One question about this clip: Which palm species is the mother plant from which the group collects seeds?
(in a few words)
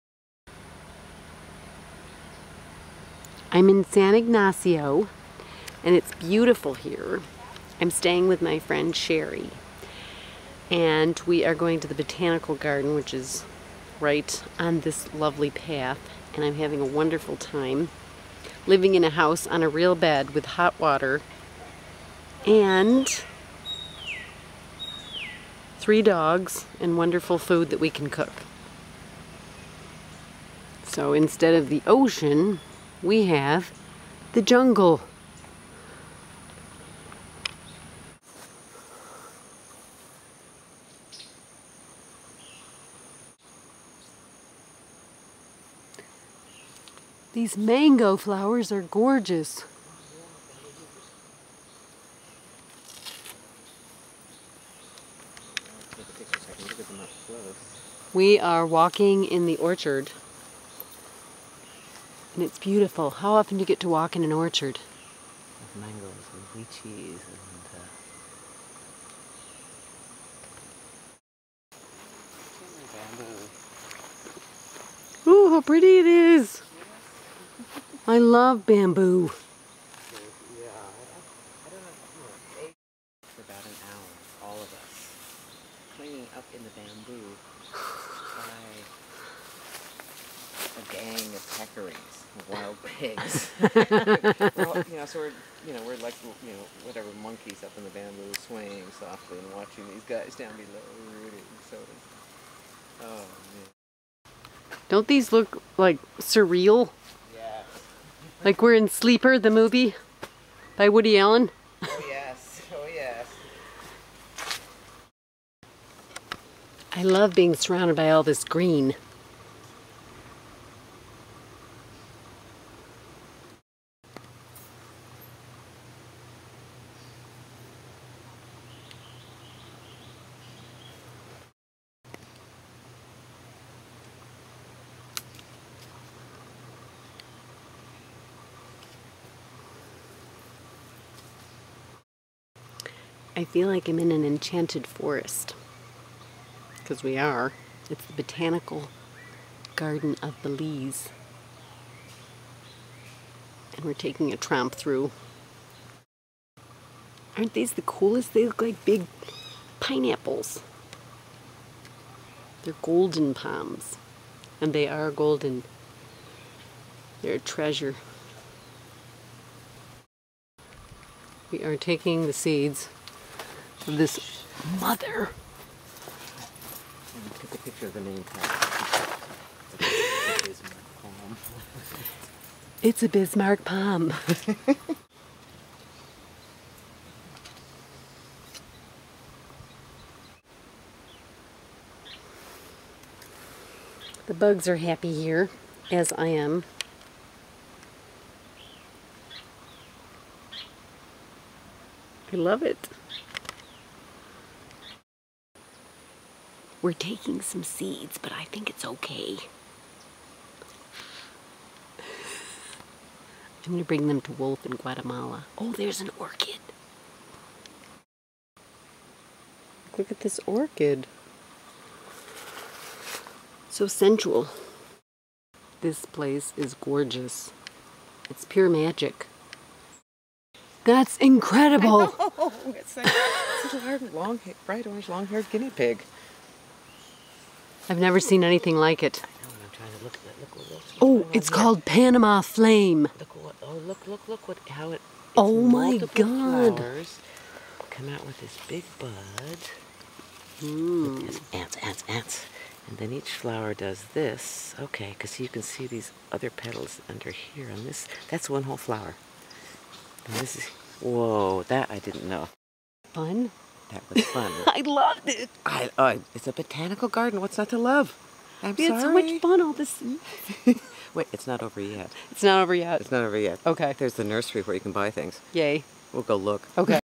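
Bismarck palm.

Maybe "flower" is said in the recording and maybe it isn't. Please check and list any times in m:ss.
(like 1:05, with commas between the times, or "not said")
0:48, 4:06, 4:13, 4:18.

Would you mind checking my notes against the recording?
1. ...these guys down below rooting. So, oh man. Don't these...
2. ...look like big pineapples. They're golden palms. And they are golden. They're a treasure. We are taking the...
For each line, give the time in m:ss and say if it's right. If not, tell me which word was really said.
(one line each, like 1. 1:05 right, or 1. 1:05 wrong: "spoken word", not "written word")
1. 1:39 right
2. 2:38 right.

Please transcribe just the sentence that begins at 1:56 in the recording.
I love being surrounded by all this green.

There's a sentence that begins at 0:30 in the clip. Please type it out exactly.
So instead of the ocean, we have the jungle.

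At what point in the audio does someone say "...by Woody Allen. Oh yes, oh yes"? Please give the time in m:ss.
1:50.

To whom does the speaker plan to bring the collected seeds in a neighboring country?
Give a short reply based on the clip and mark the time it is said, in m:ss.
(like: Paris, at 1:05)
Wolf, at 3:34.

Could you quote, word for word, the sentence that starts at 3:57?
I've never seen anything like it.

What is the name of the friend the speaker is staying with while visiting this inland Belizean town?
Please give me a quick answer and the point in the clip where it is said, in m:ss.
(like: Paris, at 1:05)
Sherry, at 0:08.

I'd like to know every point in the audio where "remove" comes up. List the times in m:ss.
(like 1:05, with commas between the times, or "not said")
not said.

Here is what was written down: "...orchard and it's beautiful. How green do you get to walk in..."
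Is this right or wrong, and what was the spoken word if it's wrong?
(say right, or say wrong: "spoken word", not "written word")
wrong: "often", not "green".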